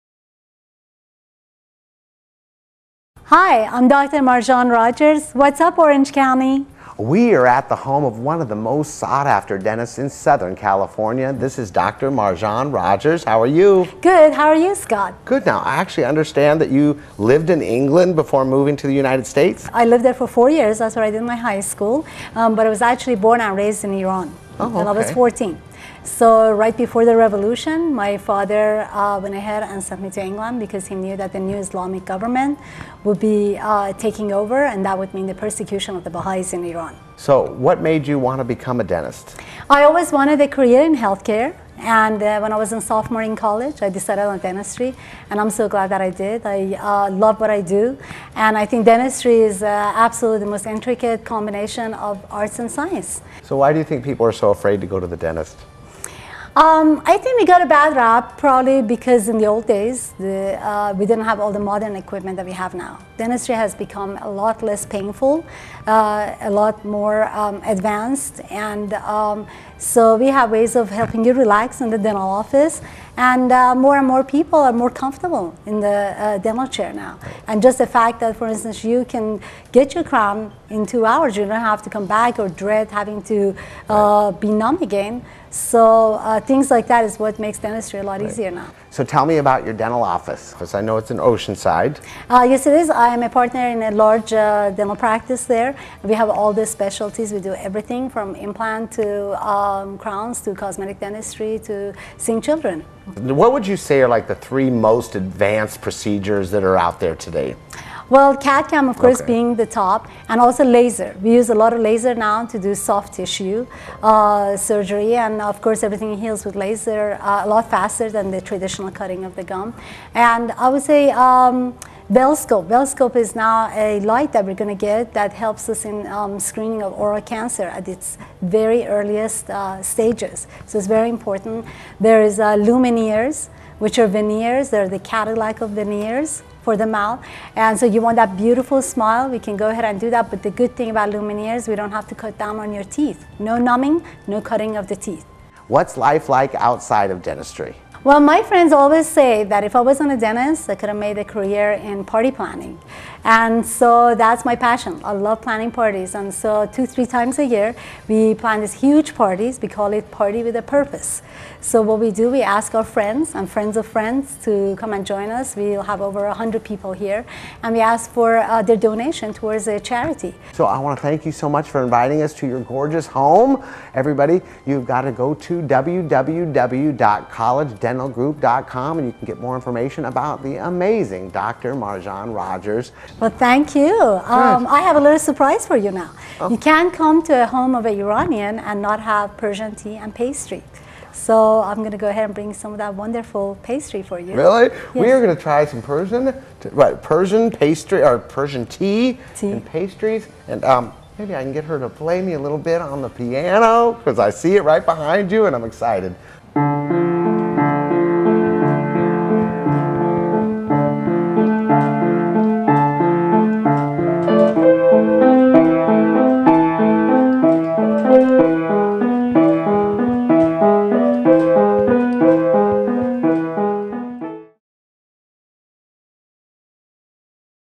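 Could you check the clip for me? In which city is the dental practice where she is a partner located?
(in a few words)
Oceanside.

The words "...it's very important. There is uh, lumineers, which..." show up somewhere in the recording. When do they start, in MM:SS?
02:10.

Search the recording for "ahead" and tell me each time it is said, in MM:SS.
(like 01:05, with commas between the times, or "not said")
00:29, 02:19, 03:12.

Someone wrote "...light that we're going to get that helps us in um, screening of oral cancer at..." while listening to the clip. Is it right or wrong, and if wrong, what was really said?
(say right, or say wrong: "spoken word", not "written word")
right.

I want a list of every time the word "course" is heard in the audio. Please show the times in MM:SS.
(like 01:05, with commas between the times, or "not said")
01:48, 01:55.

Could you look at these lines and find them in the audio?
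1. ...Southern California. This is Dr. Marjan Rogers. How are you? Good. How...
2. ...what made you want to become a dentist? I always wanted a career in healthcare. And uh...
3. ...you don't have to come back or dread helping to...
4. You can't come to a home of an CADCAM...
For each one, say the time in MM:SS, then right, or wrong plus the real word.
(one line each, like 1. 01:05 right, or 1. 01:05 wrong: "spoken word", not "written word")
1. 00:10 right
2. 00:37 right
3. 01:21 wrong: "having", not "helping"
4. 03:06 wrong: "Iranian", not "CADCAM".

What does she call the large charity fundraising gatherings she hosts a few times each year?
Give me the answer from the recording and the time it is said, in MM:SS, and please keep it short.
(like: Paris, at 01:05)
Party with a Purpose, at 02:40.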